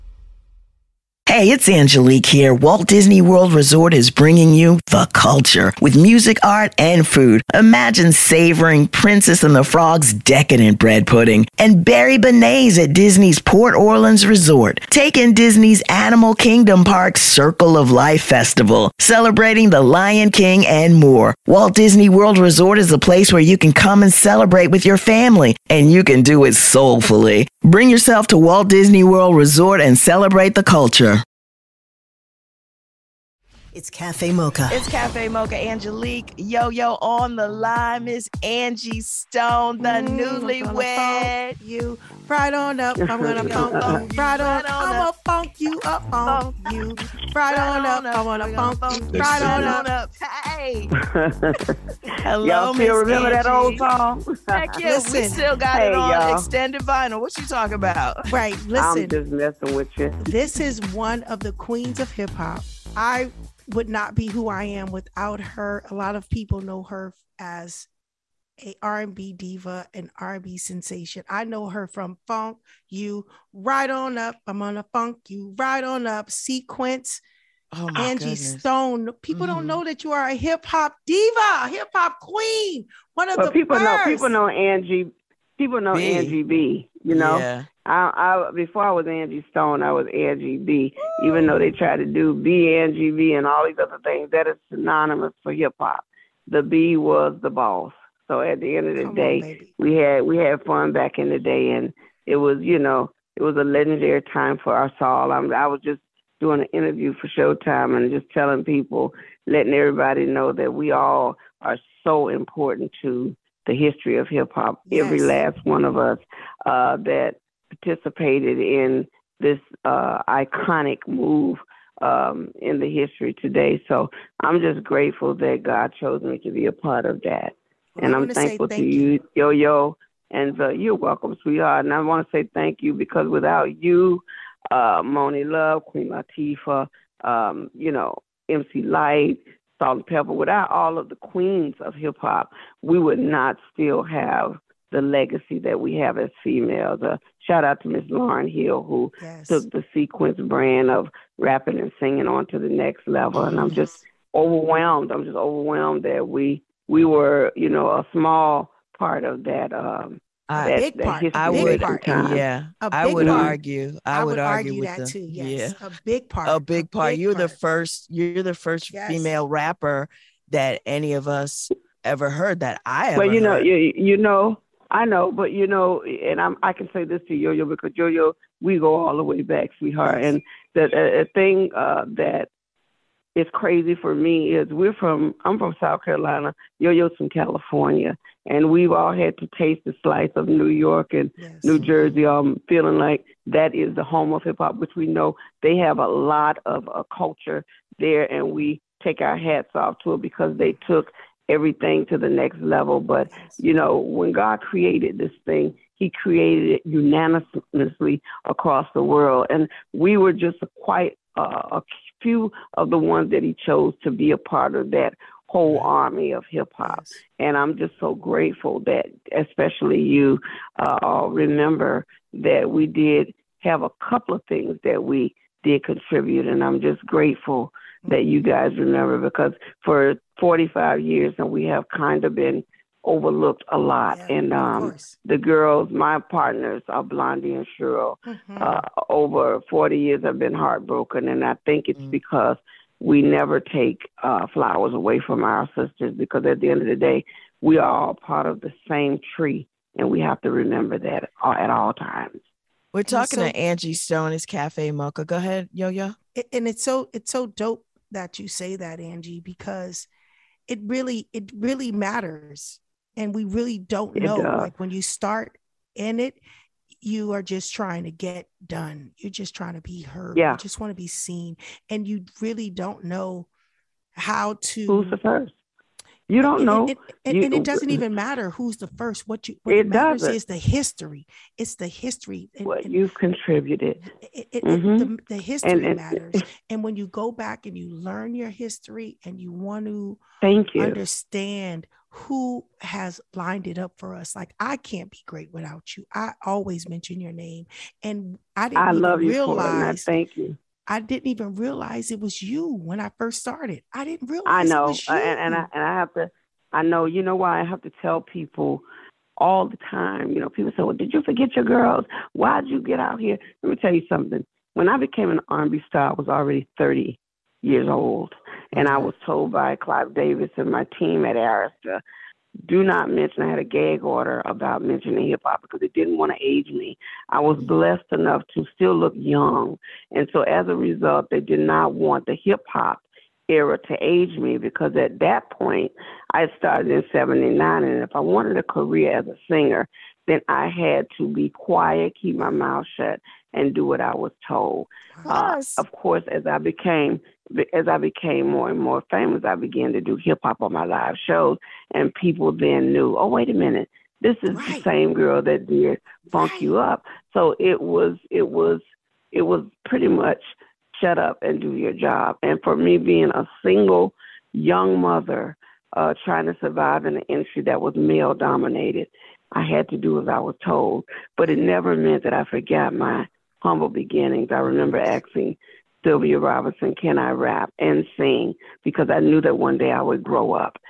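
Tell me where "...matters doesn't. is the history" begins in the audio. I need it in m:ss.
4:39.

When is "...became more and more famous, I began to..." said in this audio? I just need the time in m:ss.
5:47.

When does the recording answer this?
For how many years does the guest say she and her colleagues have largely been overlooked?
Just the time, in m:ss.
3:50.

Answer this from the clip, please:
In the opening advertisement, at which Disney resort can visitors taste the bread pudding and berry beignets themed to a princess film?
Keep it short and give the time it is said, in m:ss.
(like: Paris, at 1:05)
Disney's Port Orleans Resort, at 0:12.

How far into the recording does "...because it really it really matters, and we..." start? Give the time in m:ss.
4:19.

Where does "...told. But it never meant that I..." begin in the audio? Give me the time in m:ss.
6:10.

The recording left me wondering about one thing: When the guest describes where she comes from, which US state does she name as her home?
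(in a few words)
South Carolina.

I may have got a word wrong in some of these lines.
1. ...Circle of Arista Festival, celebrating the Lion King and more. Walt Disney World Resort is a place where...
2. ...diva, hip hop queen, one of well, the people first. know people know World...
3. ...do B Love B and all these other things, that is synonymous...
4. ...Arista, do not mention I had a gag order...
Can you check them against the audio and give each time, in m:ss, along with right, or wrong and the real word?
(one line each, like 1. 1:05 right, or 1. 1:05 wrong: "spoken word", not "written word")
1. 0:17 wrong: "Life", not "Arista"
2. 1:21 wrong: "Angie", not "World"
3. 1:32 wrong: "Angie", not "Love"
4. 5:21 right.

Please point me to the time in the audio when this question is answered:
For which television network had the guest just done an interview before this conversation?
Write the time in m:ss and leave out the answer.
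1:47.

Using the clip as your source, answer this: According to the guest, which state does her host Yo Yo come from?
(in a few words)
California.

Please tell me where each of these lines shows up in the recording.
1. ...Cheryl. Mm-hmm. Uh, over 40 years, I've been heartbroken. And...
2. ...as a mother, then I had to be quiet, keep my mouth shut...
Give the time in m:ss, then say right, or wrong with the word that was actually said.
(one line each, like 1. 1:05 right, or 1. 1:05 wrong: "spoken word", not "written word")
1. 3:57 right
2. 5:39 wrong: "singer", not "mother".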